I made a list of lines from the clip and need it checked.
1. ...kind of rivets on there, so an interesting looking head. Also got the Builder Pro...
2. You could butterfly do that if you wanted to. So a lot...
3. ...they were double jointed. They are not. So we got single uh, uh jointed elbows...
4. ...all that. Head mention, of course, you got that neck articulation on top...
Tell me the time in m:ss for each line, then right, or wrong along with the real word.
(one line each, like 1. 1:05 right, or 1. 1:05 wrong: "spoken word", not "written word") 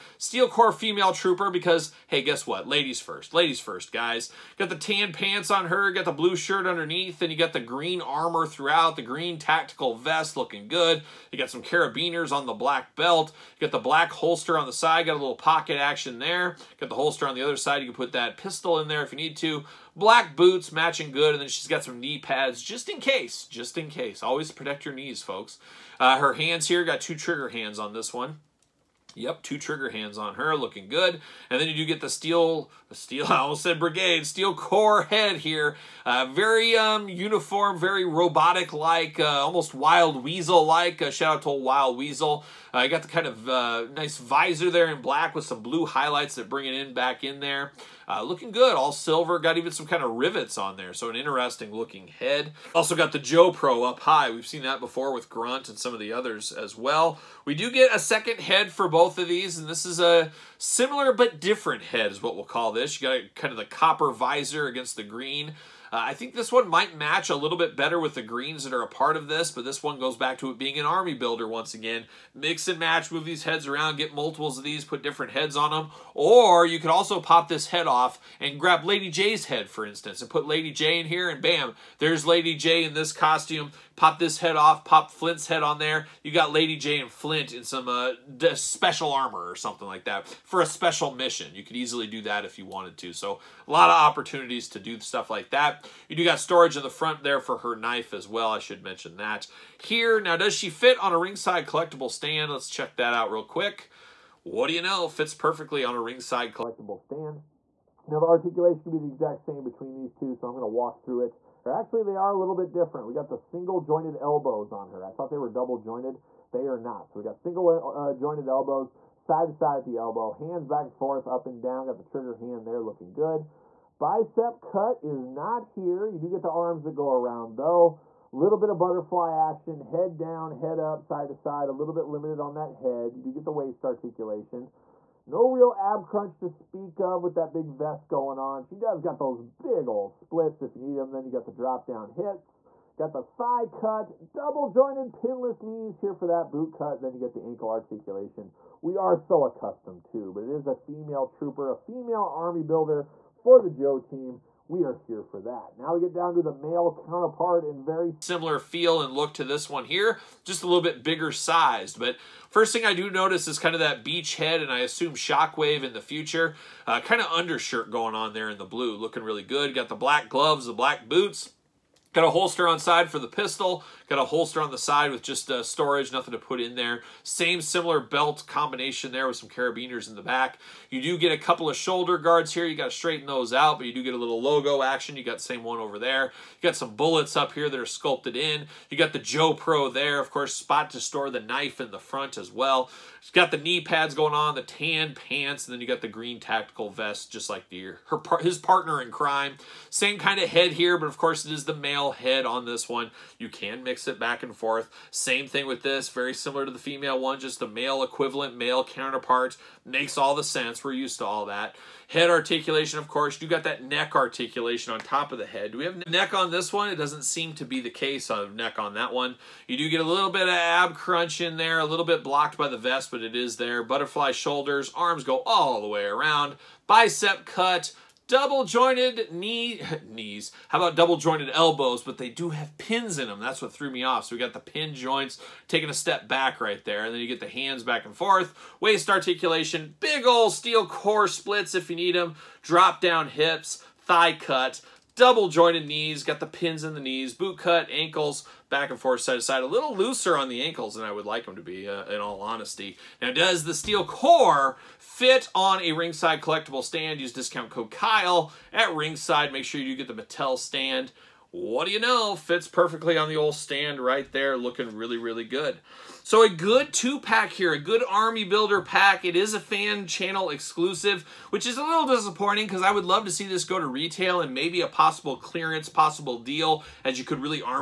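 1. 0:49 wrong: "Joe", not "Builder"
2. 1:31 wrong: "easily", not "butterfly"
3. 1:55 right
4. 3:31 wrong: "articulation", not "mention".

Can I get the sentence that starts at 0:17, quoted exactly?
You can put that pistol in there if you need to.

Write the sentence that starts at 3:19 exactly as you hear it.
Same kind of head here, but of course it is the male head on this one.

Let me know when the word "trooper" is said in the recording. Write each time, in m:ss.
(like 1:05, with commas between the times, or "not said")
0:01, 2:31.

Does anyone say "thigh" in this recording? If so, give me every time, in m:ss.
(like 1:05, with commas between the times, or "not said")
2:23, 4:03.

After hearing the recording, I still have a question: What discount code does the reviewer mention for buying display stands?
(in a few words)
Kyle.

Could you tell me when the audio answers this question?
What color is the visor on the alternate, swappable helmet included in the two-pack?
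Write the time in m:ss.
1:03.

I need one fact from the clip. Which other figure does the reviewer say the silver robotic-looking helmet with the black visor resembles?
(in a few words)
Wild Weasel.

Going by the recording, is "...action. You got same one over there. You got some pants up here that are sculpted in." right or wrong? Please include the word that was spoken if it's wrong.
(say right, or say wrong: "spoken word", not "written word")
wrong: "bullets", not "pants".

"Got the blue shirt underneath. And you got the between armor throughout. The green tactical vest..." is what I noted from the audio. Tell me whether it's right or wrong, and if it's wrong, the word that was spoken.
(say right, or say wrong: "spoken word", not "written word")
wrong: "green", not "between".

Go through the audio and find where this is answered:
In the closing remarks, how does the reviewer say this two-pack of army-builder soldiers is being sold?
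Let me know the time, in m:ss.
4:29.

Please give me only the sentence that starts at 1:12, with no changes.
Mix and match, move these heads around, get multiples of these, put different heads on them.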